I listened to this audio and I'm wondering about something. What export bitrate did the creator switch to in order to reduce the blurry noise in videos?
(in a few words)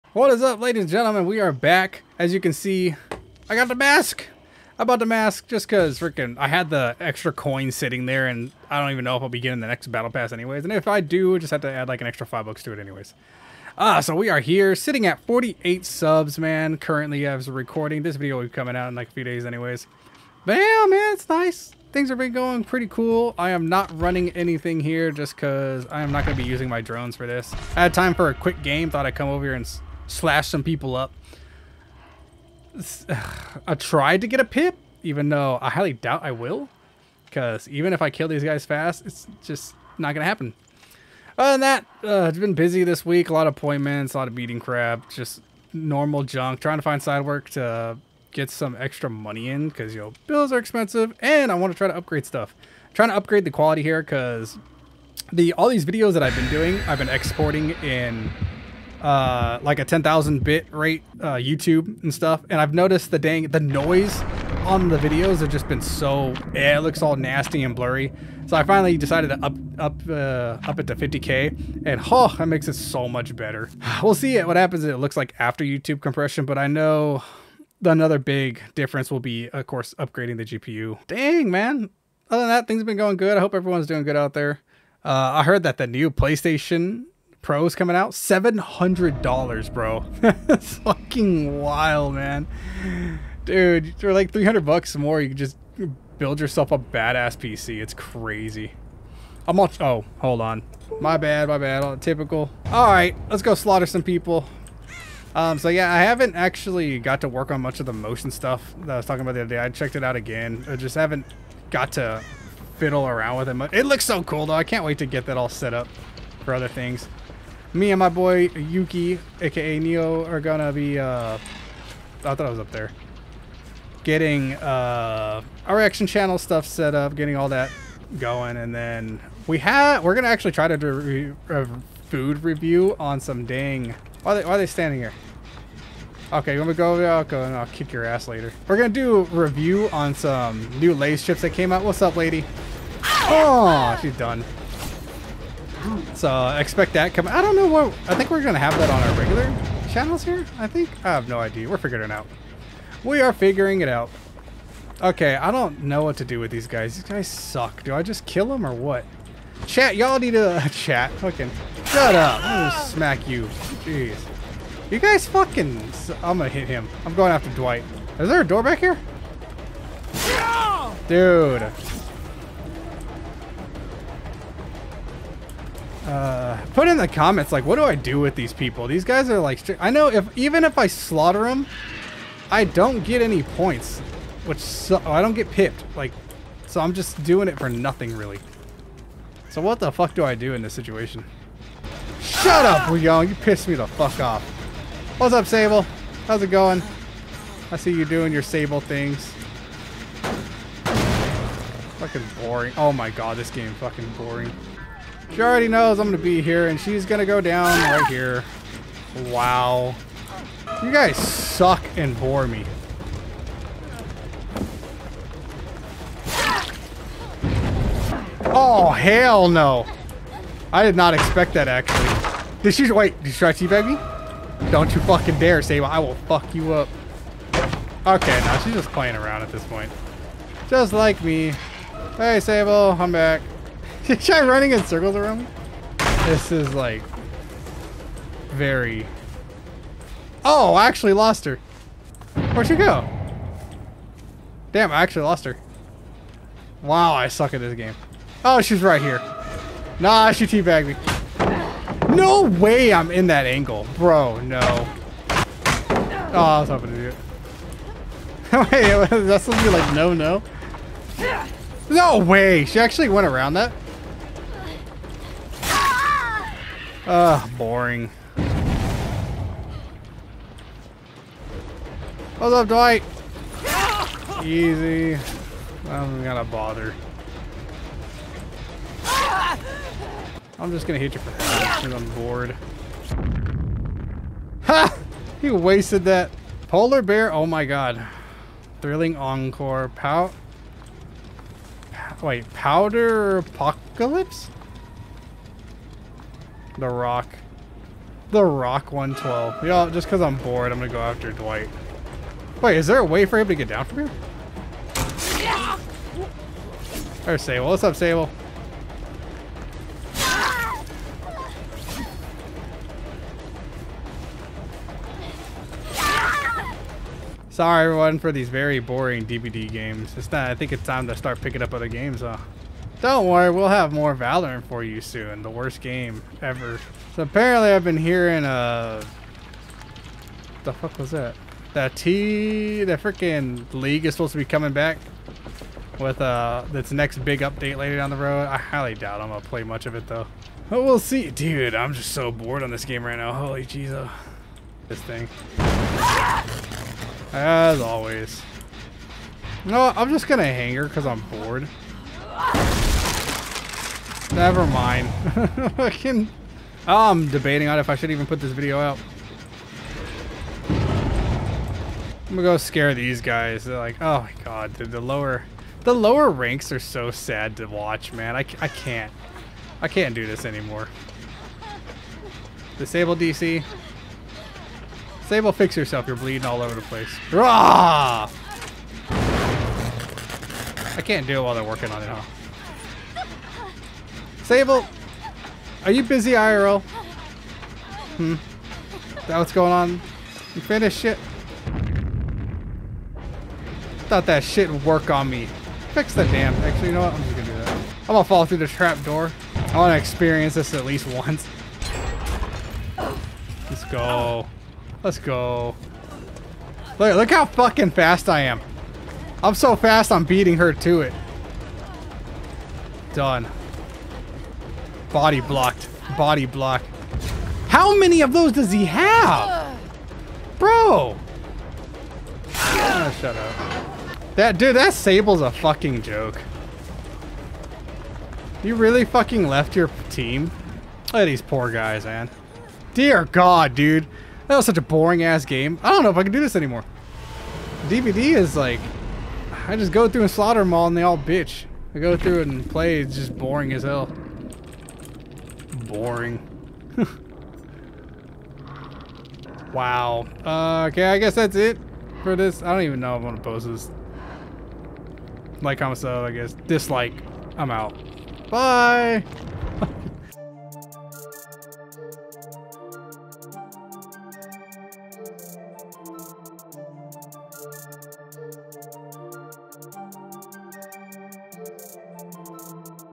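50k.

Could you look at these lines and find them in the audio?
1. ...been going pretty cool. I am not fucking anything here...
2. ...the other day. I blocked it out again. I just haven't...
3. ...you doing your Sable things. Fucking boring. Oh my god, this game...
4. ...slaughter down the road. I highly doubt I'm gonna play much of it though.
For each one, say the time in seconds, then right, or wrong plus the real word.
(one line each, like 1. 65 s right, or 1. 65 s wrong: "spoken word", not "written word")
1. 22 s wrong: "running", not "fucking"
2. 109 s wrong: "checked", not "blocked"
3. 197 s right
4. 337 s wrong: "later", not "slaughter".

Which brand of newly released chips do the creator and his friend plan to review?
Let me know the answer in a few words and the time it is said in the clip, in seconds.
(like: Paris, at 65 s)
Lay's, at 140 s.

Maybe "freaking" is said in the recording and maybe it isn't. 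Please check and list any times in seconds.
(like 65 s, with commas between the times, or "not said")
5 s, 333 s.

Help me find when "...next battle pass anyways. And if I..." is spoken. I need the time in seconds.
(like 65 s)
9 s.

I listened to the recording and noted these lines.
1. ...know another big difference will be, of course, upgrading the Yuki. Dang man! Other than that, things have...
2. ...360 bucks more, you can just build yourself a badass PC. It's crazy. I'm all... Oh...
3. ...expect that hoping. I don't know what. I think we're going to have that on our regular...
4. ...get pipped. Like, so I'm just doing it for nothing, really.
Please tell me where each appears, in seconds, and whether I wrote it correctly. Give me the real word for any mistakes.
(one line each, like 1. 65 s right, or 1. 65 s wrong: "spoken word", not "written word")
1. 76 s wrong: "GPU", not "Yuki"
2. 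94 s wrong: "300", not "360"
3. 146 s wrong: "coming", not "hoping"
4. 185 s right.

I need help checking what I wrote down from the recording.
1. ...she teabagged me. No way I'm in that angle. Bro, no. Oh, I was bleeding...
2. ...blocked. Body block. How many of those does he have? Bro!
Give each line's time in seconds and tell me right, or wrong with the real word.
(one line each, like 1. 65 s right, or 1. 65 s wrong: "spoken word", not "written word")
1. 250 s wrong: "hoping", not "bleeding"
2. 415 s right.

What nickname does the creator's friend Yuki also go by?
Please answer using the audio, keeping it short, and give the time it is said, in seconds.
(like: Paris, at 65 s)
Neo, at 119 s.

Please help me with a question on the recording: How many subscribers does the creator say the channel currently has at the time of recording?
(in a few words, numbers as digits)
48.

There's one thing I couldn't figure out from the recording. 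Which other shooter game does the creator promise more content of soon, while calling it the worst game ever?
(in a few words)
Valorant.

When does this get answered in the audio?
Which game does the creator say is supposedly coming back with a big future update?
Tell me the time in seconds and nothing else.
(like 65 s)
333 s.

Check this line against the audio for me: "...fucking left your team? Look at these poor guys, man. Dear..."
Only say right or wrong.
right.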